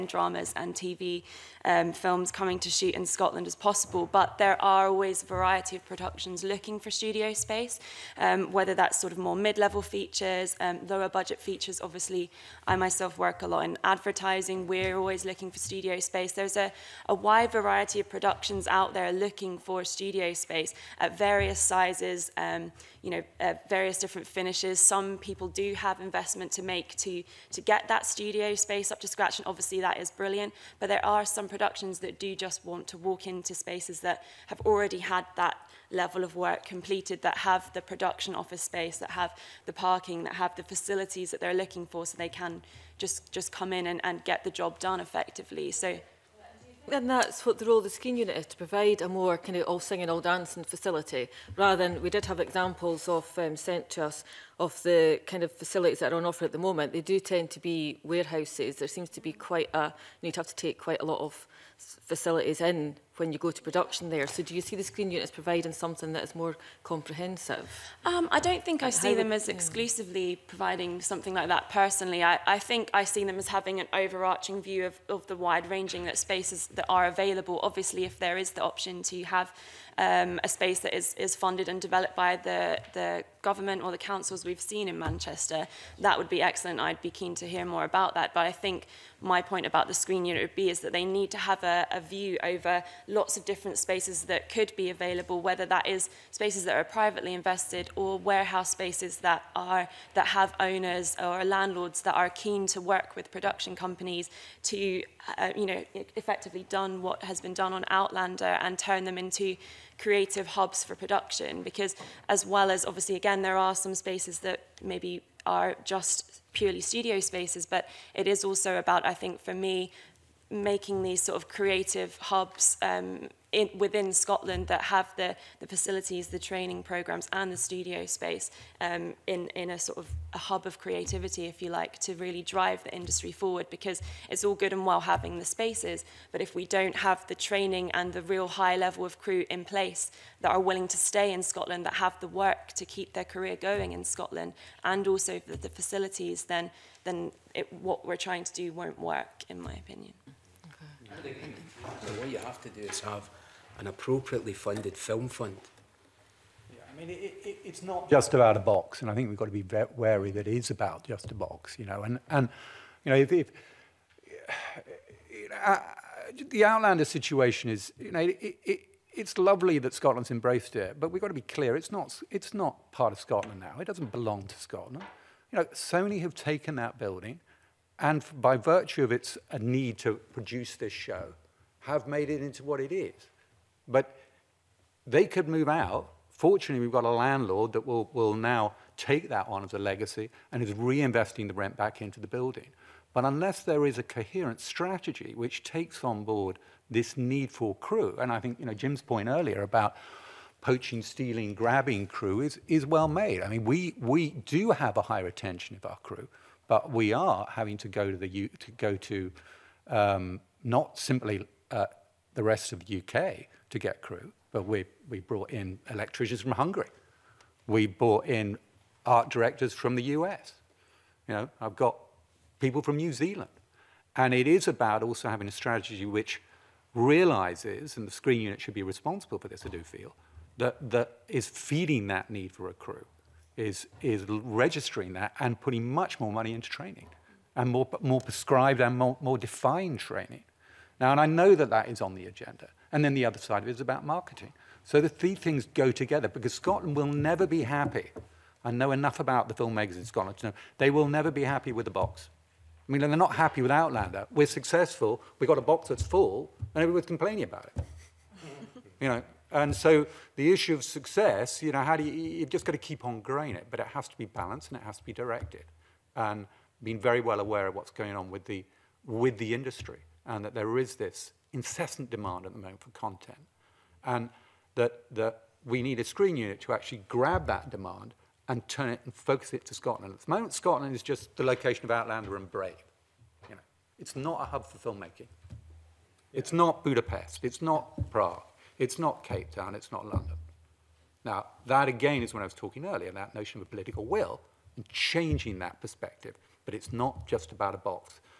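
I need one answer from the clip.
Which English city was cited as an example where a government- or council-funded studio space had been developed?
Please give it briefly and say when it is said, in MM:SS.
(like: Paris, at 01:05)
Manchester, at 01:24.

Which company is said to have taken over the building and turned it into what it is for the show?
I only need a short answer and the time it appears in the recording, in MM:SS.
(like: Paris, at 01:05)
Sony, at 02:55.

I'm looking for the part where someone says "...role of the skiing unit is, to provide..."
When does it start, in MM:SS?
00:47.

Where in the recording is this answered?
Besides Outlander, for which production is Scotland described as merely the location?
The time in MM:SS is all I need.
04:42.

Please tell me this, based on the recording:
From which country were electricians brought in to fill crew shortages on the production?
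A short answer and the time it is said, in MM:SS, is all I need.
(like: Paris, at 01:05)
Hungary, at 03:36.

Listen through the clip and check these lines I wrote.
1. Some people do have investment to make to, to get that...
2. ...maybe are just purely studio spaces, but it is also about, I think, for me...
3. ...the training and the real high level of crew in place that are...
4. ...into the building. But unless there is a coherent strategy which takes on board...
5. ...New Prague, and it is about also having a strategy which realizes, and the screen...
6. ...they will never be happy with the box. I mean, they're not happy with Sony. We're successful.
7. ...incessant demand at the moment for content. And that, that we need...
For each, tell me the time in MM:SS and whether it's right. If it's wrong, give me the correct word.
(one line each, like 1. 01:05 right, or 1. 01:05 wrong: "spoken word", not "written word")
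1. 00:24 right
2. 01:54 right
3. 02:17 right
4. 03:12 right
5. 03:42 wrong: "Zealand", not "Prague"
6. 04:10 wrong: "Outlander", not "Sony"
7. 04:31 right.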